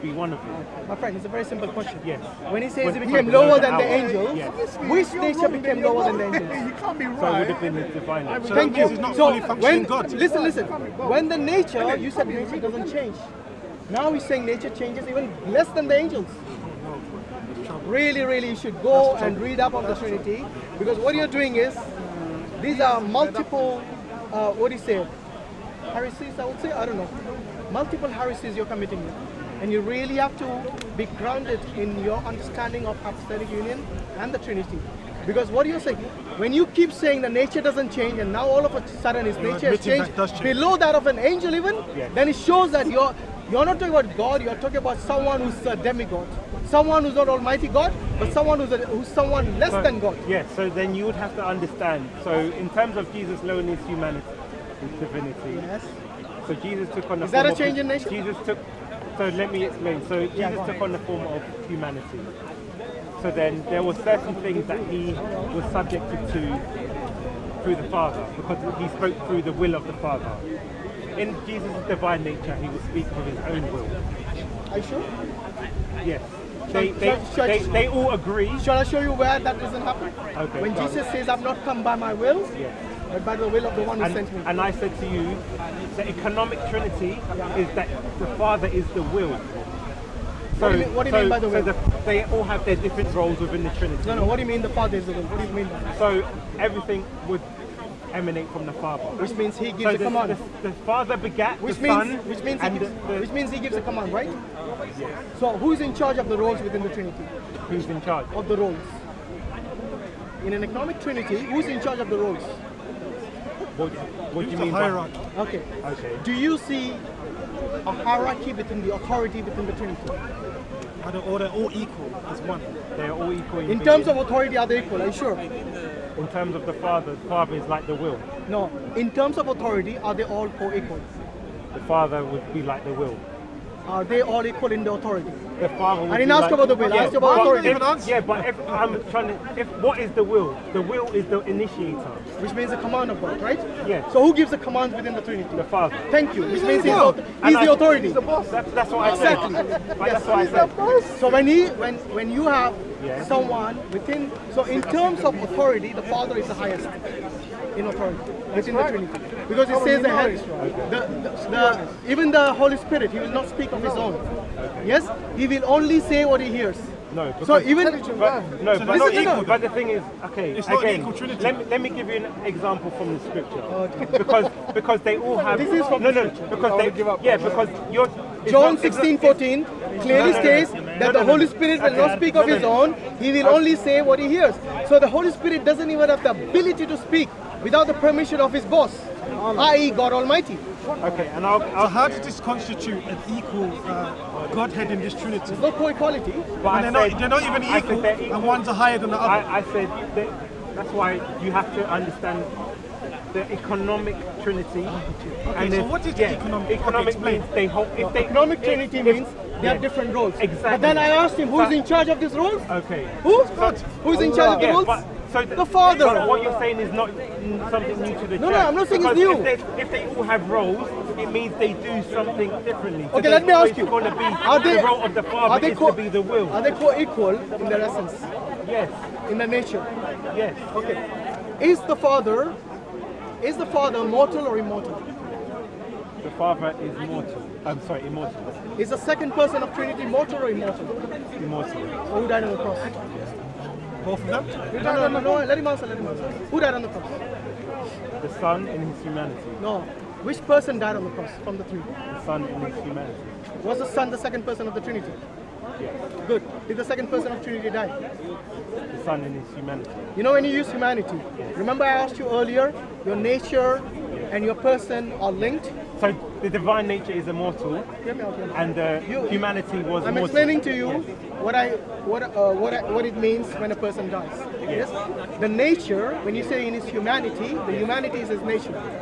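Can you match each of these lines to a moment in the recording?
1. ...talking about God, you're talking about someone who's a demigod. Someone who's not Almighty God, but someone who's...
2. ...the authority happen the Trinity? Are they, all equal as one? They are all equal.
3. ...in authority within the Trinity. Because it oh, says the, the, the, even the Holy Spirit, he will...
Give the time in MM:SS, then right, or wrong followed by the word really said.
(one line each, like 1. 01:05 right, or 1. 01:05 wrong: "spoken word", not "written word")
1. 00:43 right
2. 01:58 wrong: "between", not "happen"
3. 02:37 right.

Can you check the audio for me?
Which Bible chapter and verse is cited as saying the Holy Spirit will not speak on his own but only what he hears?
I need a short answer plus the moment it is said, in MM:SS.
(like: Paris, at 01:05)
John 16:14, at 02:58.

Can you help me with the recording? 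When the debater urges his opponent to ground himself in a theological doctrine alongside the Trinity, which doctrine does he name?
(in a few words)
Hypostatic Union.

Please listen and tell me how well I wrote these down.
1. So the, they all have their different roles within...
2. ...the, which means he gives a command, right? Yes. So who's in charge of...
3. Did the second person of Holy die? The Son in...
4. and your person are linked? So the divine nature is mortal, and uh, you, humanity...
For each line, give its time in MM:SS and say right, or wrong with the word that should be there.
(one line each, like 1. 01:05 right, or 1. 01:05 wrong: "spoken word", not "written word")
1. 01:31 right
2. 01:42 right
3. 04:16 wrong: "Trinity", not "Holy"
4. 04:24 wrong: "immortal", not "mortal".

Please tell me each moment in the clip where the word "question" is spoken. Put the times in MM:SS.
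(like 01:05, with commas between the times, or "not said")
00:01.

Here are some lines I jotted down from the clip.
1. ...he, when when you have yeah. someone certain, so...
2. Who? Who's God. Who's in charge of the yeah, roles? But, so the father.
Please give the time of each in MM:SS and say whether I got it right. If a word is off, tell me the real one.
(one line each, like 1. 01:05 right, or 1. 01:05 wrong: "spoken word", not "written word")
1. 02:31 wrong: "within", not "certain"
2. 03:33 right.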